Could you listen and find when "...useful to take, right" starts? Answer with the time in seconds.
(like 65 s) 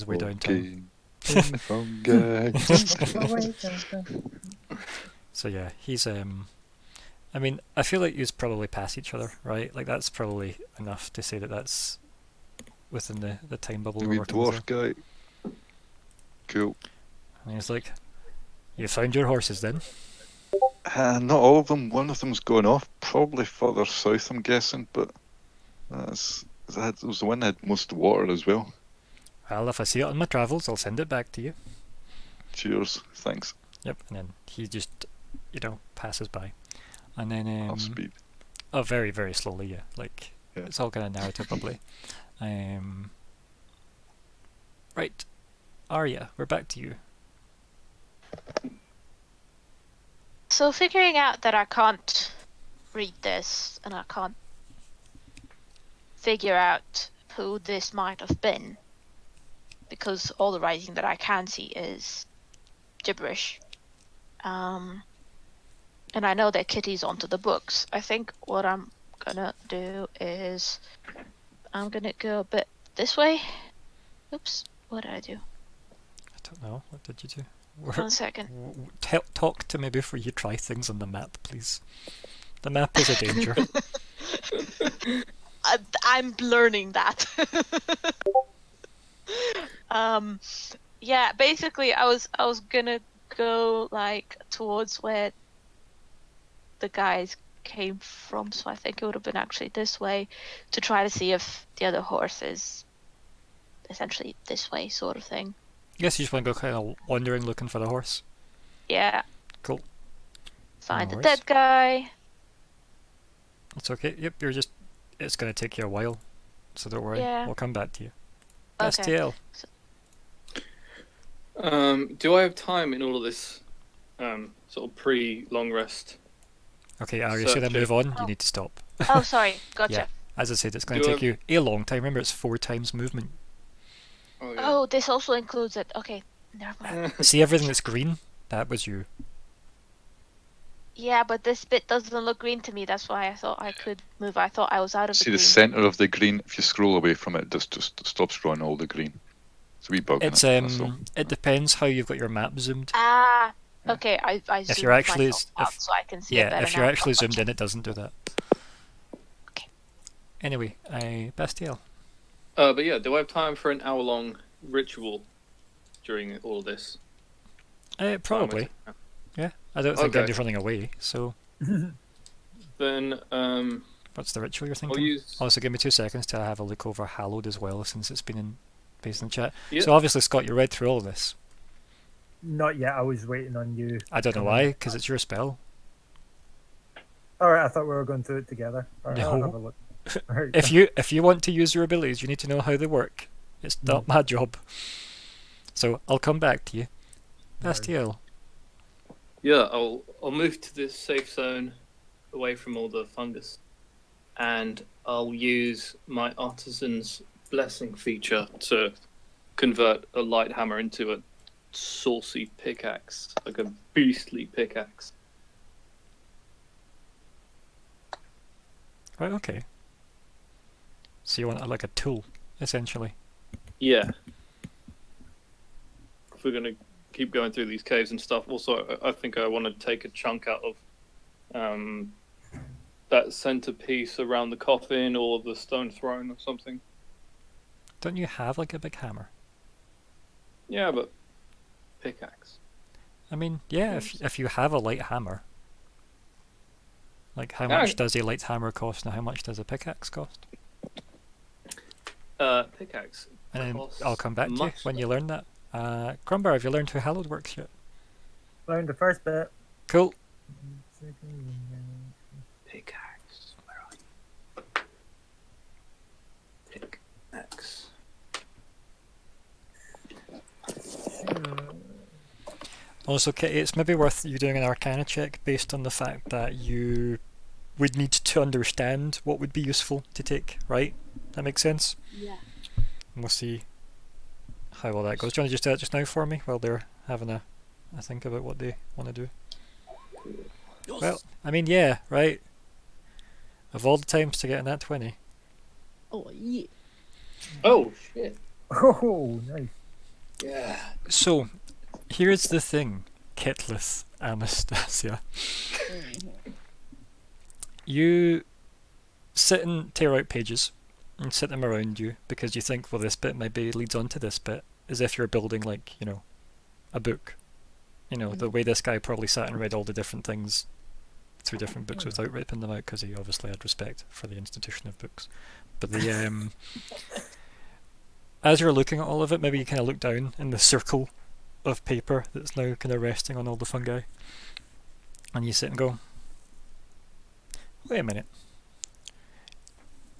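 279 s.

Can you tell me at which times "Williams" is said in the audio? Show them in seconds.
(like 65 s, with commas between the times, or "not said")
not said.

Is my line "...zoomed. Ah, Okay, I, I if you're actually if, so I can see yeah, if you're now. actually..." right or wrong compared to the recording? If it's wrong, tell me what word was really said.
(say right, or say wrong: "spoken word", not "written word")
right.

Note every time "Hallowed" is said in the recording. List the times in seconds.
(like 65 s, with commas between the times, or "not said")
177 s, 256 s.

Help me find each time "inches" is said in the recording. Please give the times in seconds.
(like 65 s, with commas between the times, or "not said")
not said.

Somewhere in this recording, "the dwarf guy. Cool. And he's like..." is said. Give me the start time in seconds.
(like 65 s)
14 s.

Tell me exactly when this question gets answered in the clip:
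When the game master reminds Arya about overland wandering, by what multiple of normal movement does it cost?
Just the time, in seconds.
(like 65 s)
132 s.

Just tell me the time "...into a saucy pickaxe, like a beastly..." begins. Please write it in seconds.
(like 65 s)
210 s.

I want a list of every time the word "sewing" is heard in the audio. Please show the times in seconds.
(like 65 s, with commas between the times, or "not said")
not said.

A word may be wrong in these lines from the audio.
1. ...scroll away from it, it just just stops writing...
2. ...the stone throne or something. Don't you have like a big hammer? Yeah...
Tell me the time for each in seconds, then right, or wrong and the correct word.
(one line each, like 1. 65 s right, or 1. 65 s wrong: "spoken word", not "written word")
1. 146 s wrong: "drawing", not "writing"
2. 235 s right.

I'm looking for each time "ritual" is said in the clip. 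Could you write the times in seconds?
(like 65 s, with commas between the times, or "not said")
164 s, 174 s.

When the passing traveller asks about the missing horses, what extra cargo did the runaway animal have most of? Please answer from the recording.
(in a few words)
water.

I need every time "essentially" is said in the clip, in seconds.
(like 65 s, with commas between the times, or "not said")
103 s, 222 s.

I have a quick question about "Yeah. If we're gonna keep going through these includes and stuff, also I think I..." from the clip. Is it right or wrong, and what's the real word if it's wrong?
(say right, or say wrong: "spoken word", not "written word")
wrong: "caves", not "includes".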